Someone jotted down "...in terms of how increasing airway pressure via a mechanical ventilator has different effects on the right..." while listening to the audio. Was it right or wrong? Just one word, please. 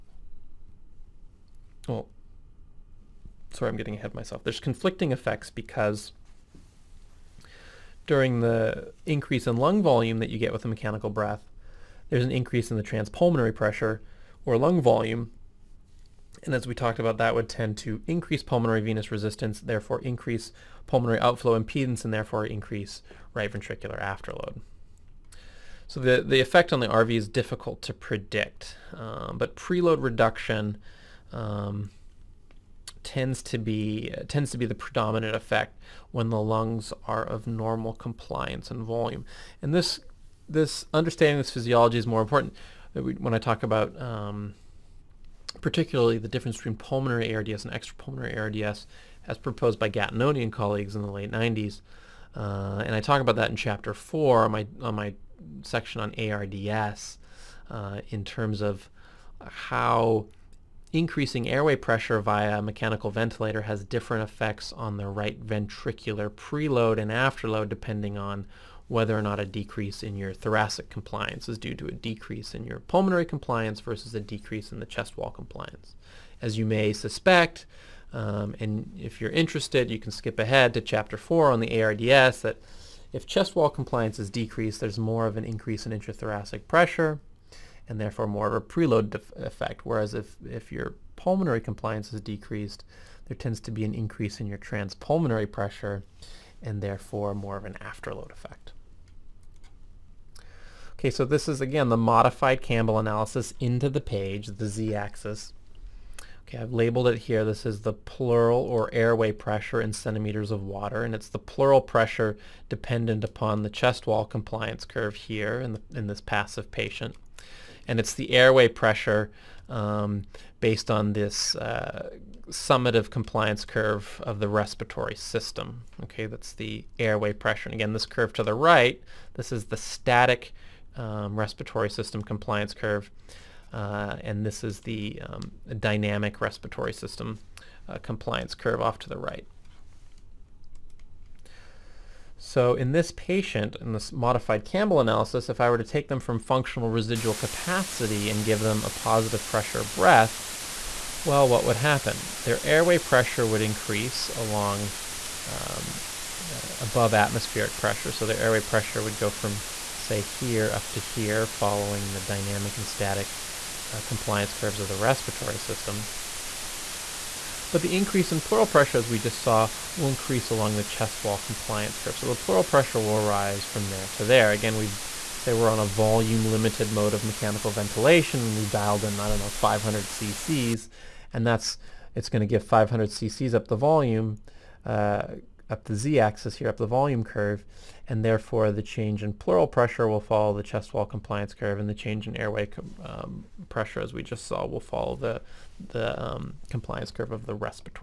right.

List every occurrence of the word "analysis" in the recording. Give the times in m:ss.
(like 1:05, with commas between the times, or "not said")
1:42, 2:24.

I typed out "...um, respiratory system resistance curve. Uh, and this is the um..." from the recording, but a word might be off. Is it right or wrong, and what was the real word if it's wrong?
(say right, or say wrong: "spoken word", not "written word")
wrong: "compliance", not "resistance".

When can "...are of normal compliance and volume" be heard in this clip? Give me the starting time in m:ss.
0:37.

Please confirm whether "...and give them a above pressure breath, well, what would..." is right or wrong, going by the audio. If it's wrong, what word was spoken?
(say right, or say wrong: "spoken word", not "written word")
wrong: "positive", not "above".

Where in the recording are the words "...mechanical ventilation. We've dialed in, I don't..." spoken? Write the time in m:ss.
2:57.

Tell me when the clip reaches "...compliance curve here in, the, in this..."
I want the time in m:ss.
1:54.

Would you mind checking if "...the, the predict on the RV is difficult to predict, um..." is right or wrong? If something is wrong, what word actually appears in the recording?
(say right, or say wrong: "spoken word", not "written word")
wrong: "effect", not "predict".